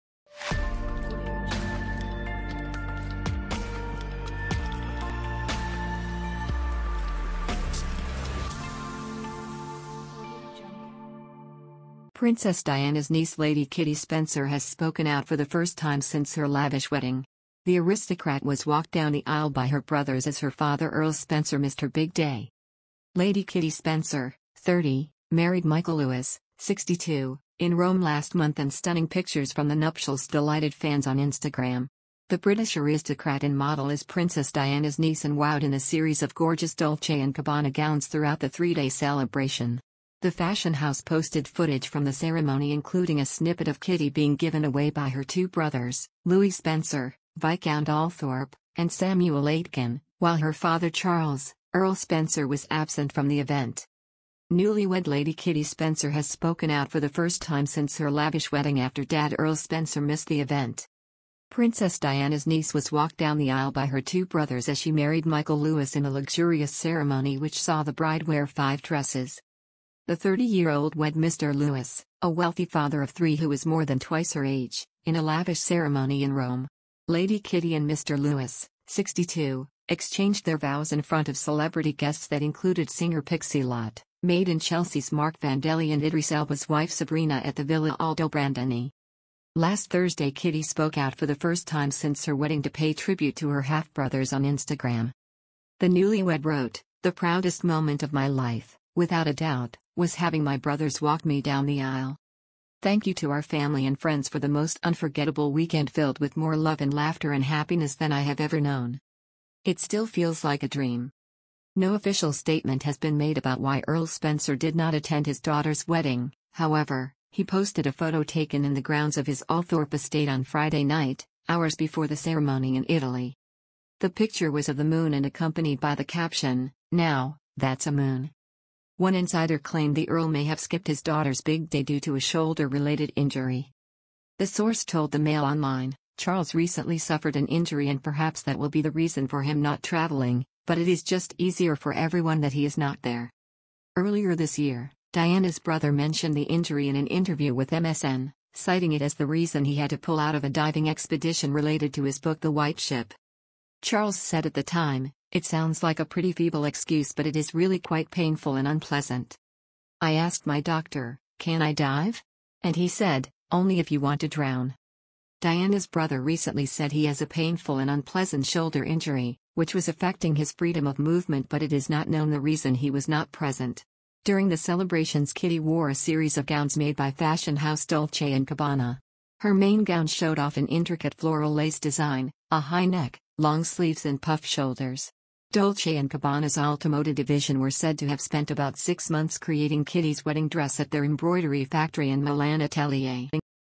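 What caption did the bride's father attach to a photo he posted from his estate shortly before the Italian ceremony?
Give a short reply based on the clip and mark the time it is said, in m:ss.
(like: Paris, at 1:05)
Now, that's a moon, at 2:06.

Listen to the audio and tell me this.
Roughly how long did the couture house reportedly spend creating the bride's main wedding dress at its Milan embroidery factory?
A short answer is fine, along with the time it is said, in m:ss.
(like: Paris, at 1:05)
About 6 months, at 3:08.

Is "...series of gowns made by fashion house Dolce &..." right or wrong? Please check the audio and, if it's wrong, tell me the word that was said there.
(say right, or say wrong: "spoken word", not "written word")
right.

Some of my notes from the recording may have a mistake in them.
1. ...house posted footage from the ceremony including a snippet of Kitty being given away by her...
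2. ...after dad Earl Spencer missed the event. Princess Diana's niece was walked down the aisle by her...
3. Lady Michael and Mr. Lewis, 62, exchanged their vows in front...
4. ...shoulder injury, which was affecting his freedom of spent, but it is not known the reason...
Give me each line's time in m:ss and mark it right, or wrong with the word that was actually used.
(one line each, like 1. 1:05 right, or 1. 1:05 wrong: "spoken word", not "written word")
1. 0:40 right
2. 0:58 right
3. 1:17 wrong: "Kitty", not "Michael"
4. 2:48 wrong: "movement", not "spent".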